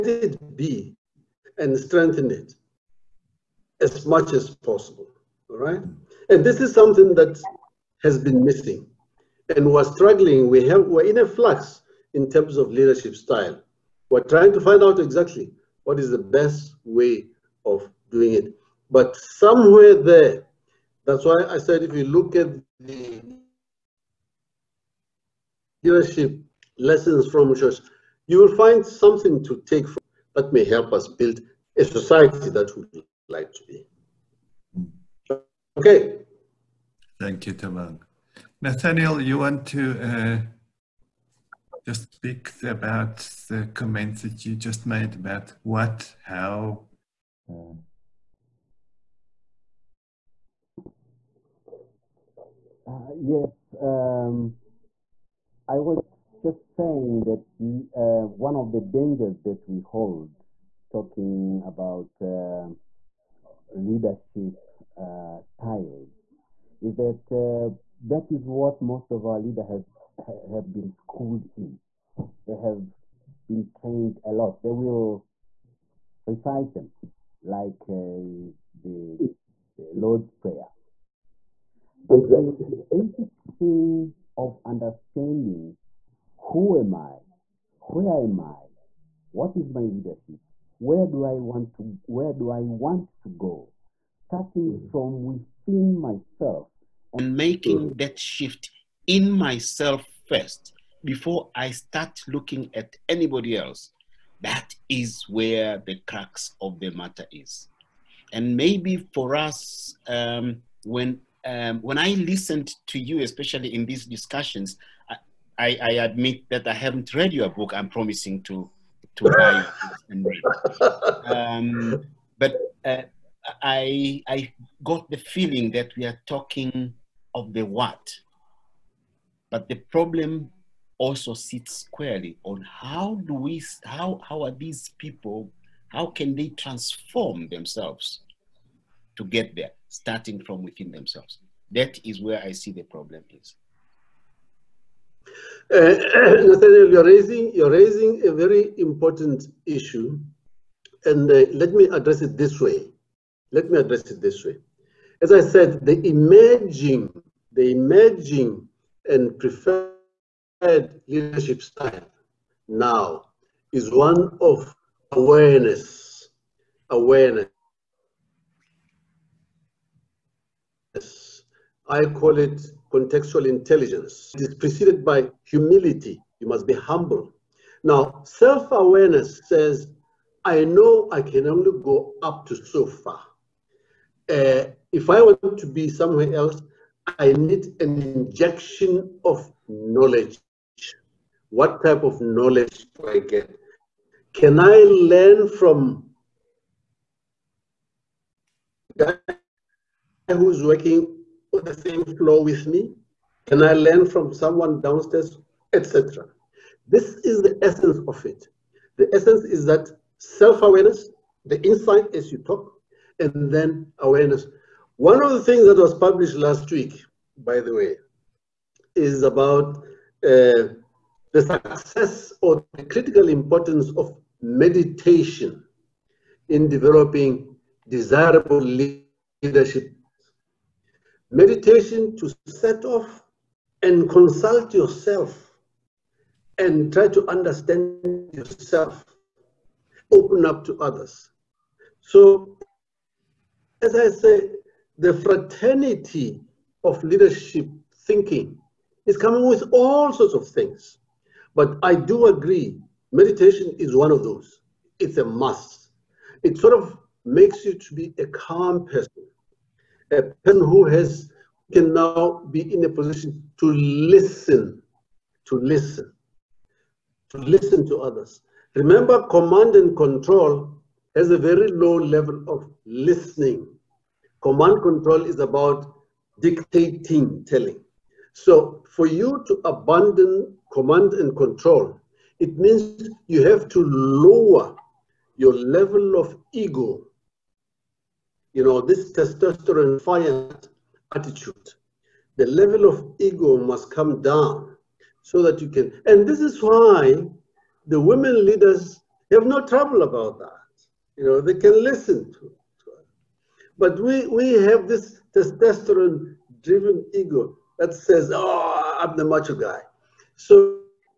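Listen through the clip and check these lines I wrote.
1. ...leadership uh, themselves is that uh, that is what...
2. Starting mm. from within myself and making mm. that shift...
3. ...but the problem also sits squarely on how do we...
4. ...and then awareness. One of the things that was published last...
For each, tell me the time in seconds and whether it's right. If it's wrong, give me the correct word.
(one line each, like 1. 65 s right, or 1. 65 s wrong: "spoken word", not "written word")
1. 63 s wrong: "styles", not "themselves"
2. 94 s right
3. 129 s right
4. 213 s right.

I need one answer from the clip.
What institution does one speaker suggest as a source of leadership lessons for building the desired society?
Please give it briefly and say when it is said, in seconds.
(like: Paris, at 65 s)
Church, at 27 s.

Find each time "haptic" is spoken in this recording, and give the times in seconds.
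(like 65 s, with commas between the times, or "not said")
not said.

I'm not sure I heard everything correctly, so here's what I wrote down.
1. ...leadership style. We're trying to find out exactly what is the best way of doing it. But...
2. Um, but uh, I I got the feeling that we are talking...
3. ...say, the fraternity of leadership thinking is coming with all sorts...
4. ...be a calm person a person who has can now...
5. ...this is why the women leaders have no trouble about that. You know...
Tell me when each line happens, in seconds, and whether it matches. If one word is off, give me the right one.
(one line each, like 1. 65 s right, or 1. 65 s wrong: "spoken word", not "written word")
1. 12 s right
2. 121 s right
3. 244 s right
4. 257 s right
5. 296 s right.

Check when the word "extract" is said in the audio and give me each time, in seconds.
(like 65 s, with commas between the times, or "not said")
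not said.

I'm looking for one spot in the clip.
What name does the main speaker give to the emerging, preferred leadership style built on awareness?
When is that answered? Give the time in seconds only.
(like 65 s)
172 s.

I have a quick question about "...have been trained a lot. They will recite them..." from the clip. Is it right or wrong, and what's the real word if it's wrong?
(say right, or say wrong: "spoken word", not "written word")
right.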